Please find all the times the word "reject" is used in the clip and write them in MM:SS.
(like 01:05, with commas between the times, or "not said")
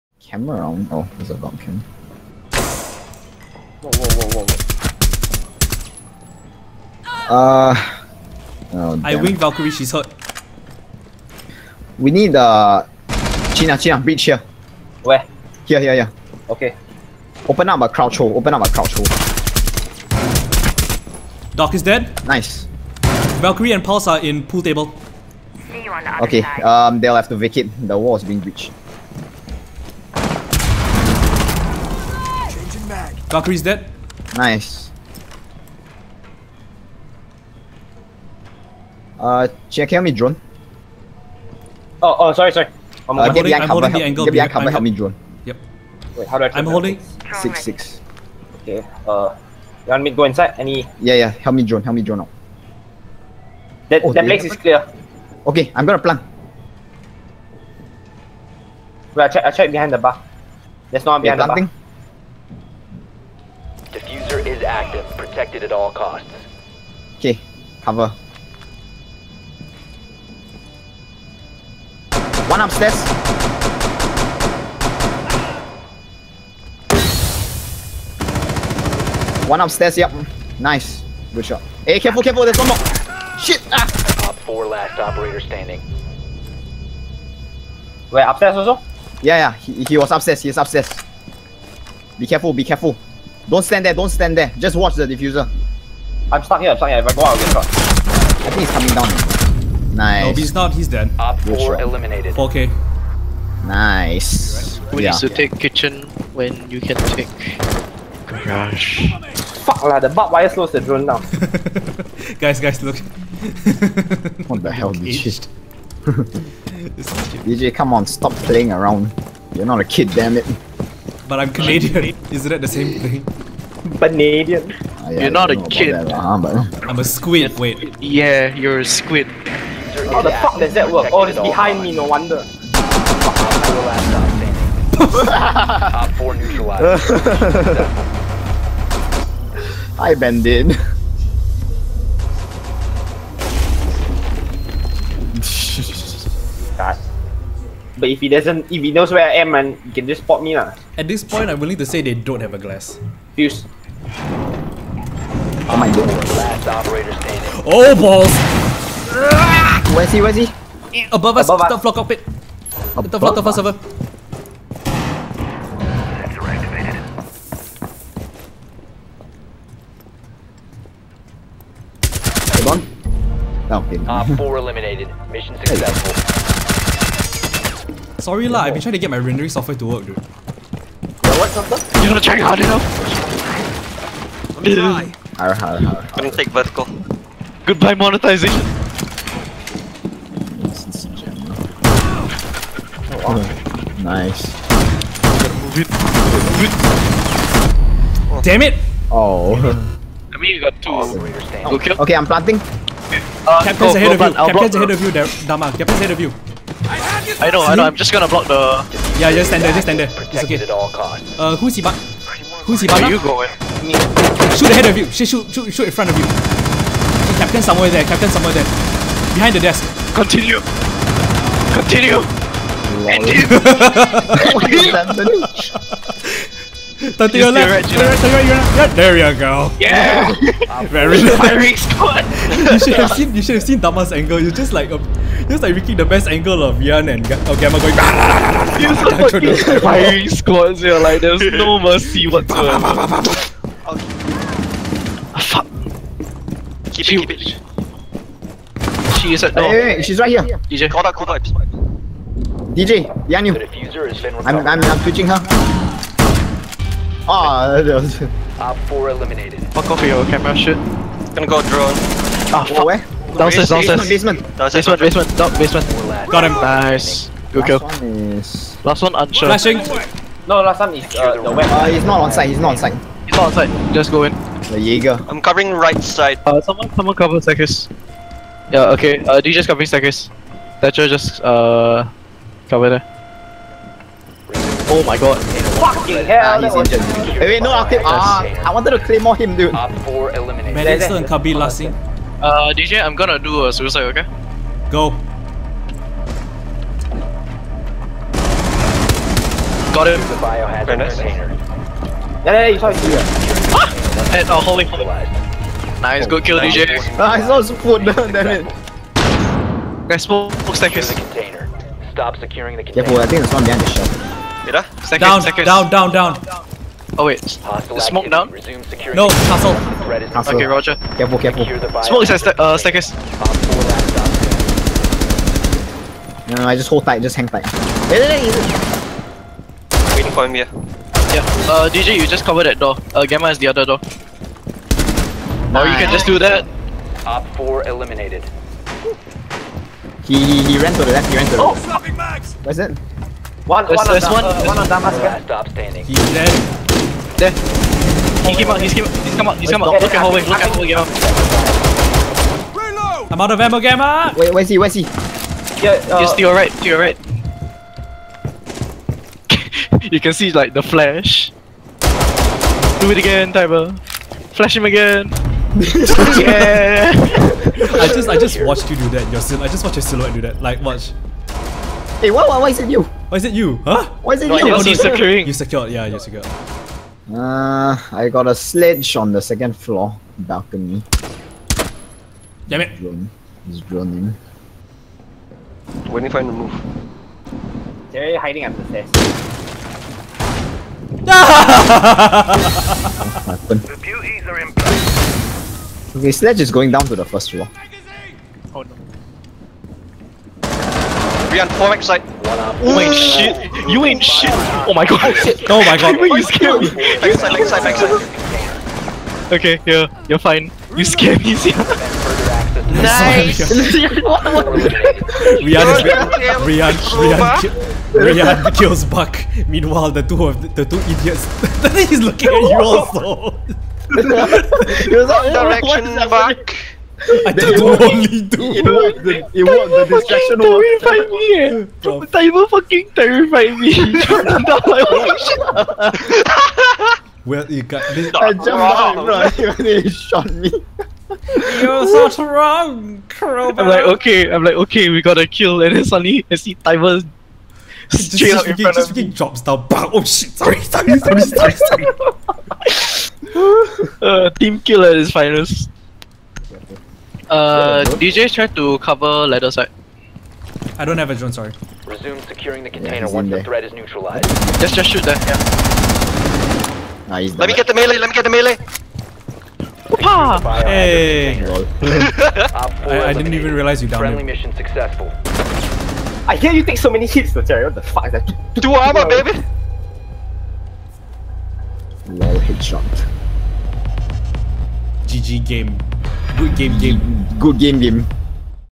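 not said.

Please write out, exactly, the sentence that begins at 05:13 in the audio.
Yeah, boy, I think there's one behind the shelf.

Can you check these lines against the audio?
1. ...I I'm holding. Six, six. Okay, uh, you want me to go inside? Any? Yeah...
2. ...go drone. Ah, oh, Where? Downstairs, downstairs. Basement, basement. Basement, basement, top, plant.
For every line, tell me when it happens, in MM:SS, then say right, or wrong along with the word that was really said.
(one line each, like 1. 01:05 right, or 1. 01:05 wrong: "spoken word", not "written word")
1. 00:46 right
2. 04:21 wrong: "basement", not "plant".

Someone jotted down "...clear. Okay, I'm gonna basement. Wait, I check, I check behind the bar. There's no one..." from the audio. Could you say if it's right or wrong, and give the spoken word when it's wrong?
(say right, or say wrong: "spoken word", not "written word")
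wrong: "plant", not "basement".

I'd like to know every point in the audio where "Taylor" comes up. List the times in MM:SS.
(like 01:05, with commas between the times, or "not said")
not said.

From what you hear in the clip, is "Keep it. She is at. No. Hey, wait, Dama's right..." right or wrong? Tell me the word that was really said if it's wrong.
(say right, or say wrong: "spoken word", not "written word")
wrong: "She", not "Dama".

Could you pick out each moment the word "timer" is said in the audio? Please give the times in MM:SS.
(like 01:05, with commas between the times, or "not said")
07:12, 07:26.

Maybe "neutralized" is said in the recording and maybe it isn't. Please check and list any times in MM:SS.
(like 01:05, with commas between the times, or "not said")
02:16, 07:43.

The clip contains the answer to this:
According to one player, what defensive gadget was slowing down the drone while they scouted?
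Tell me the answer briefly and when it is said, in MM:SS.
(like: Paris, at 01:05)
bug wire, at 01:50.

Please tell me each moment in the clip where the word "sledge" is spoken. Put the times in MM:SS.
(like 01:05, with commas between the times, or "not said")
06:18, 06:36.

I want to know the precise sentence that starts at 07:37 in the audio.
Uh, DJ to cover ladder side.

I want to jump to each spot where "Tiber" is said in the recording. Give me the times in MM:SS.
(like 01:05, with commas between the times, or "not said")
06:03.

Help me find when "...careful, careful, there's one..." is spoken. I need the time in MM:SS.
01:22.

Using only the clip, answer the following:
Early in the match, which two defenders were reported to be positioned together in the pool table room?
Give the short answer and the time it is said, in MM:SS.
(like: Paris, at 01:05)
Valkyrie and Pulse, at 00:23.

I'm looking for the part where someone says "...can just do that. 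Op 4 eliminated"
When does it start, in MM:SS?
05:35.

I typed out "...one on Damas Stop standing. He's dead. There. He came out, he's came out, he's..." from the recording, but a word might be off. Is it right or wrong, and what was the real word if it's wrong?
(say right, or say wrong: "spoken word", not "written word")
right.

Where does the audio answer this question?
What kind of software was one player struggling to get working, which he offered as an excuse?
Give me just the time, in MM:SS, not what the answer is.
02:59.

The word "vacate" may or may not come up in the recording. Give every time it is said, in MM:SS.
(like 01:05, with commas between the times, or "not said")
00:27.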